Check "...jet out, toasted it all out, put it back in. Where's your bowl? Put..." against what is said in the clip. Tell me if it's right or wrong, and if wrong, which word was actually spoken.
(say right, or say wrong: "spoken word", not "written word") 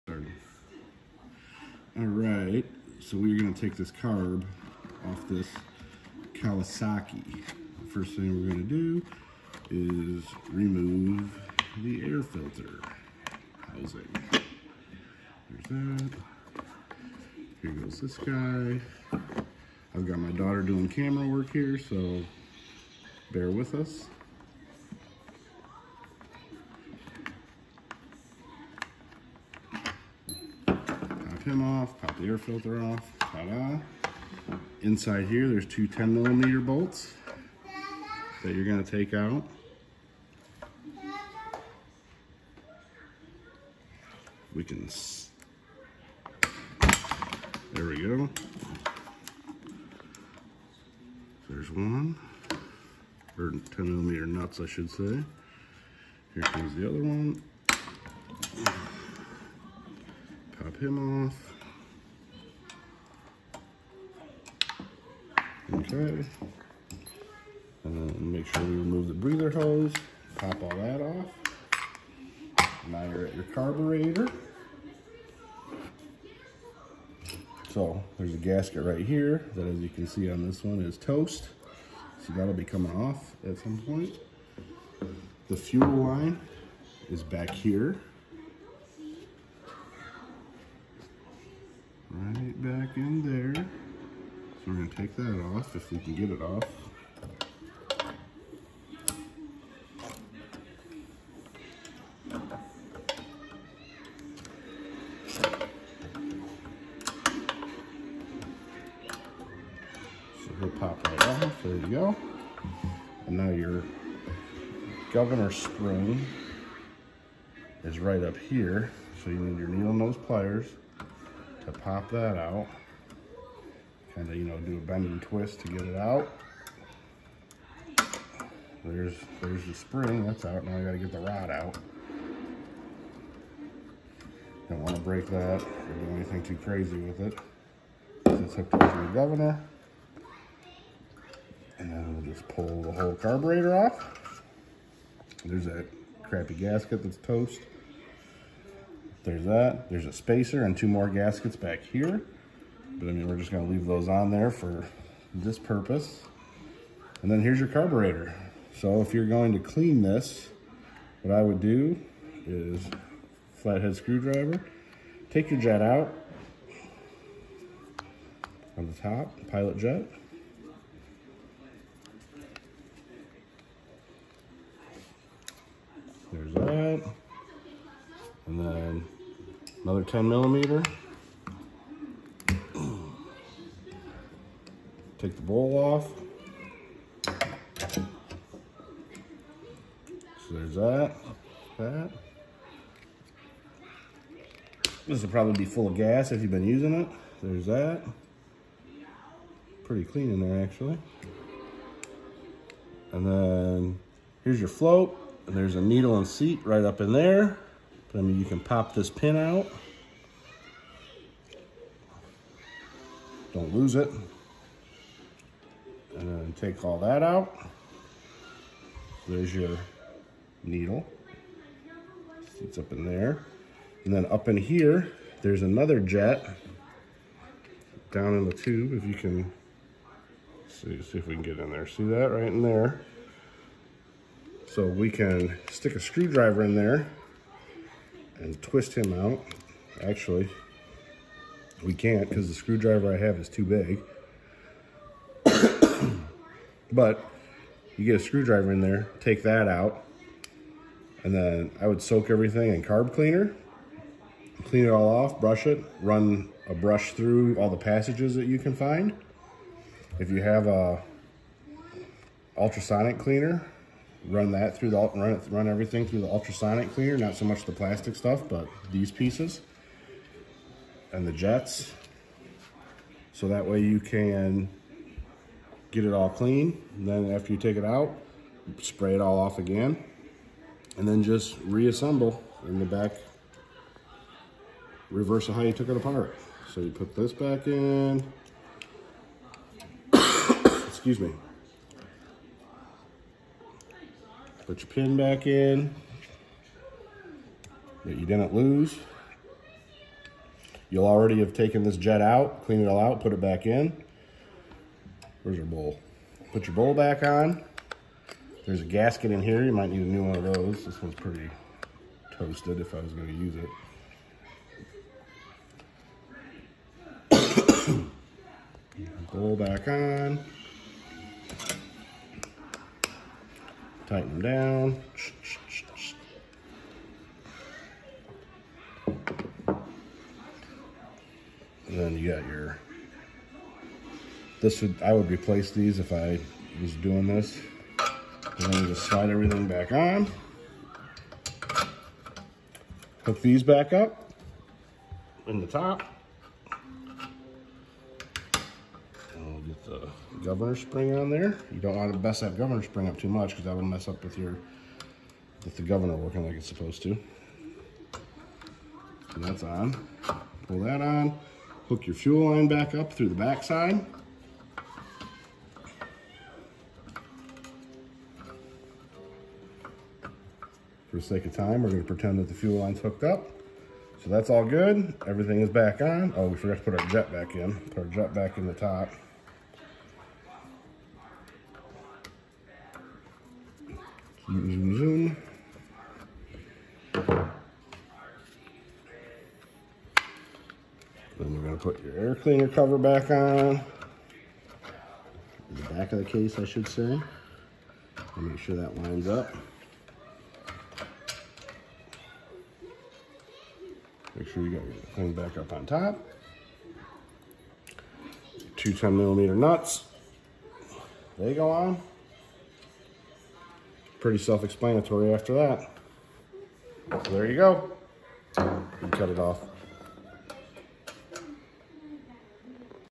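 wrong: "cleaned", not "toasted".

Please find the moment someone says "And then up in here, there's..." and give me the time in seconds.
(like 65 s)
224 s.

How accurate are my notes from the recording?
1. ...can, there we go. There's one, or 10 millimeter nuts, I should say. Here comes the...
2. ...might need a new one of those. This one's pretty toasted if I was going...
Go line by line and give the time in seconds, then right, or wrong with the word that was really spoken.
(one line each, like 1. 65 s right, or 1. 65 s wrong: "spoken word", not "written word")
1. 44 s right
2. 309 s right.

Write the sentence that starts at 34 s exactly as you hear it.
Inside here, there's two 10 millimeter bolts that you're gonna take out.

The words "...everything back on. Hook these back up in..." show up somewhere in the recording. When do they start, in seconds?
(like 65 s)
339 s.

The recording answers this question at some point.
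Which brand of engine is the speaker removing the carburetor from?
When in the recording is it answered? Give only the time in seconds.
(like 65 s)
6 s.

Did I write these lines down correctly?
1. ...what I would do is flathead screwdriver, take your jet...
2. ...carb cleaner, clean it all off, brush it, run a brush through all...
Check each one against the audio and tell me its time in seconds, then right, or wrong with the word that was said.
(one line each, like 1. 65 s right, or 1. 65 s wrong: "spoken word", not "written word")
1. 161 s right
2. 252 s right.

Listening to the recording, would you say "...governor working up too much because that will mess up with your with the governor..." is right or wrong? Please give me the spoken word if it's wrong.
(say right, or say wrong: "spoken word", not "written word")
wrong: "spring", not "working".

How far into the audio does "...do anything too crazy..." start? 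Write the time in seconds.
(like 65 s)
136 s.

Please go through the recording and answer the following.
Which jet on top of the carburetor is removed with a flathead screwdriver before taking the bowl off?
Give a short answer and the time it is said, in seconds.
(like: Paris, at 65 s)
pilot jet, at 169 s.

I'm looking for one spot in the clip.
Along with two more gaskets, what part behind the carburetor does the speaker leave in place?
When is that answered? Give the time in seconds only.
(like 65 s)
150 s.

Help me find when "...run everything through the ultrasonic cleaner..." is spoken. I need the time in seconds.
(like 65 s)
265 s.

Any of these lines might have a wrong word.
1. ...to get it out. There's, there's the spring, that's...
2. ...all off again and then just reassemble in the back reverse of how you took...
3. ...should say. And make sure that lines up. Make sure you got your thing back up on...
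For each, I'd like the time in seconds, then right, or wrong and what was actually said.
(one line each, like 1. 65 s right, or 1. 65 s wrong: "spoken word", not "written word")
1. 125 s right
2. 279 s right
3. 396 s right.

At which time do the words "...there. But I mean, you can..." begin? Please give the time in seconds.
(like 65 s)
207 s.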